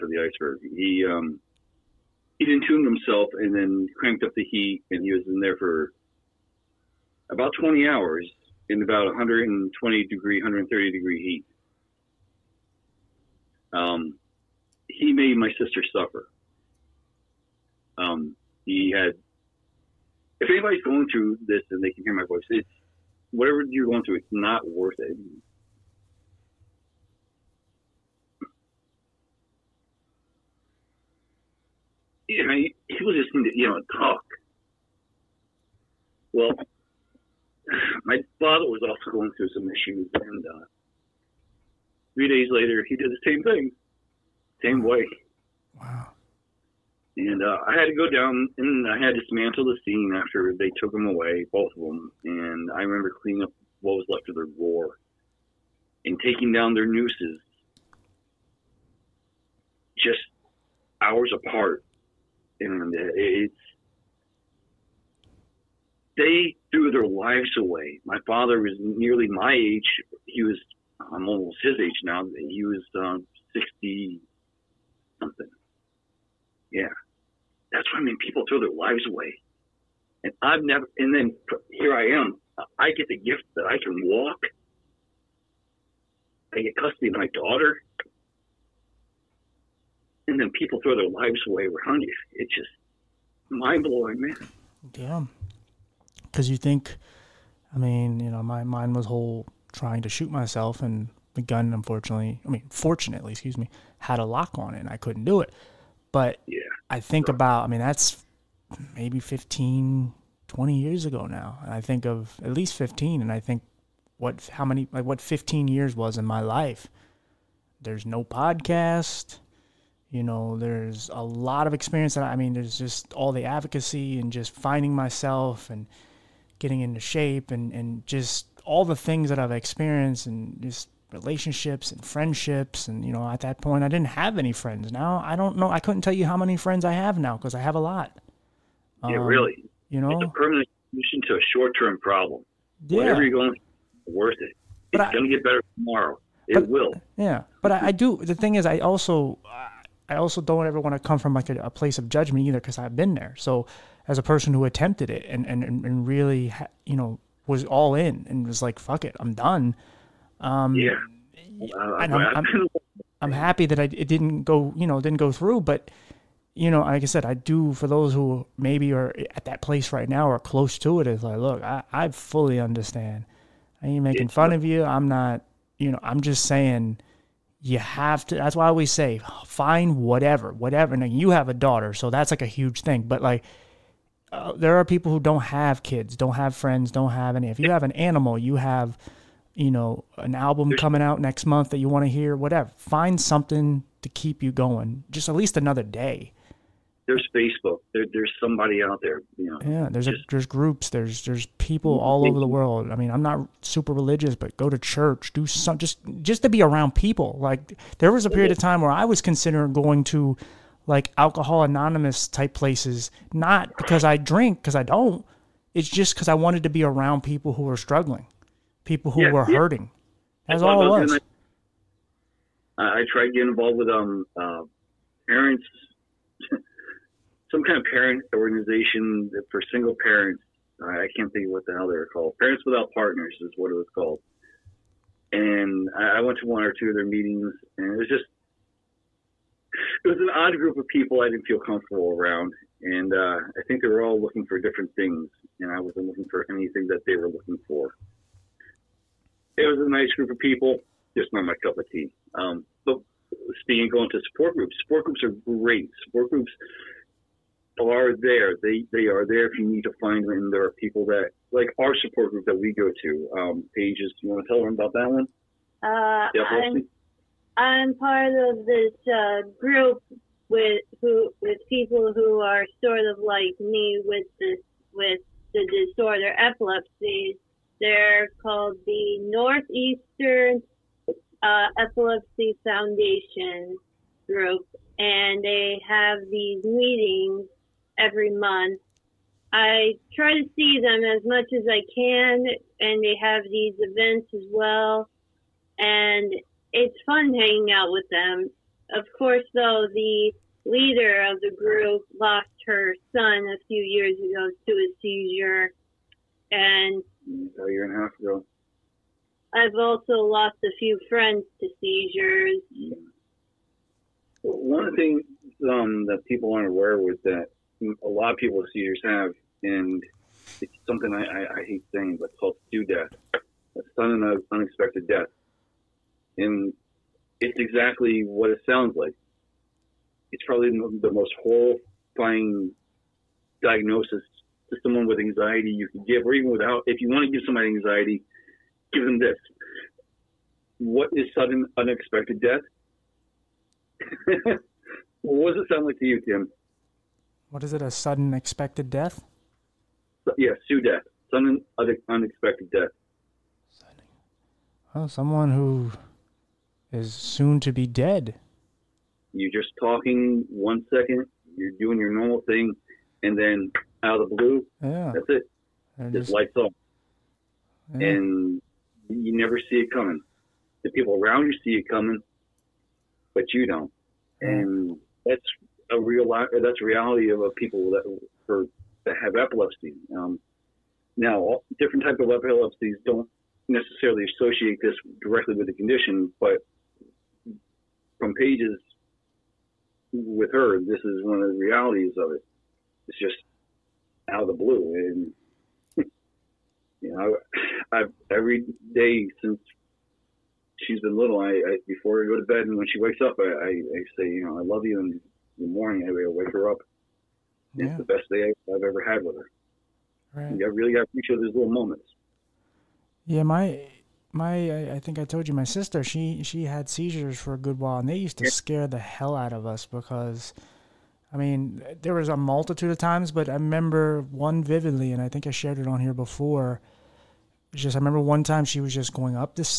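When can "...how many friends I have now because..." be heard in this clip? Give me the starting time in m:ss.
2:16.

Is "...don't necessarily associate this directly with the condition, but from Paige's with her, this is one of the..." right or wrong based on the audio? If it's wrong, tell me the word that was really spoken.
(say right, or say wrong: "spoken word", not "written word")
right.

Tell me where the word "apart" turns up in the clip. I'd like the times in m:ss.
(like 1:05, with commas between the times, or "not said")
1:01.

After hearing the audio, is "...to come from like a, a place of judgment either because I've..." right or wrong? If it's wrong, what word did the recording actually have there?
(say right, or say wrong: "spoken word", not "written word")
right.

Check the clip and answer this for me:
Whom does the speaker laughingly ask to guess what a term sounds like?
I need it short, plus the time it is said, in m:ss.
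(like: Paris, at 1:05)
Tim, at 5:46.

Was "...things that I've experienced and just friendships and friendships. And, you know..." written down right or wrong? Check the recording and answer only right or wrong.
wrong.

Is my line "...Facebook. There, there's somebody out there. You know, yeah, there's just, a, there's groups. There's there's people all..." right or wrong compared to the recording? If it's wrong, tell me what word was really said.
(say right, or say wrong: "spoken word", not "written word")
right.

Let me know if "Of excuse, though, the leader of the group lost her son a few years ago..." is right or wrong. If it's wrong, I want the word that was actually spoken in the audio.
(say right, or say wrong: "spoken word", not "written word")
wrong: "course", not "excuse".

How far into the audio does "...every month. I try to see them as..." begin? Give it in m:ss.
4:47.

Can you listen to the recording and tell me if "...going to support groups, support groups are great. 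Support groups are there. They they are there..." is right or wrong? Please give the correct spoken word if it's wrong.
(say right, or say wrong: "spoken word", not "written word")
right.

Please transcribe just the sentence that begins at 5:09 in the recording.
I've also lost a few friends to seizures.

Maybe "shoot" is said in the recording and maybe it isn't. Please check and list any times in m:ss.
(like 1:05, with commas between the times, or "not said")
1:40.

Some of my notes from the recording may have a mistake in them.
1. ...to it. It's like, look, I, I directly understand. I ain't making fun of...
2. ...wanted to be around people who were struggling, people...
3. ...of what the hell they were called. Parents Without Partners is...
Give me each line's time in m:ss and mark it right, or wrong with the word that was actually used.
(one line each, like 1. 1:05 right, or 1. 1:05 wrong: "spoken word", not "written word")
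1. 2:50 wrong: "fully", not "directly"
2. 3:36 right
3. 3:51 right.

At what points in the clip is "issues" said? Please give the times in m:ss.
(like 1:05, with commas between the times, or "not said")
0:39.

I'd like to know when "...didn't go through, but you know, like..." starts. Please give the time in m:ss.
2:44.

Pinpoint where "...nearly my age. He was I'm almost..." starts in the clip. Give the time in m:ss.
1:08.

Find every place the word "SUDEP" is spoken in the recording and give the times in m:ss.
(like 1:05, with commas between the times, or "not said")
5:22, 5:50.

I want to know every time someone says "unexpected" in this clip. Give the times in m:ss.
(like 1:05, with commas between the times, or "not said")
5:24, 5:41, 5:52.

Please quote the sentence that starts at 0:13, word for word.
Um, he made my sister suffer.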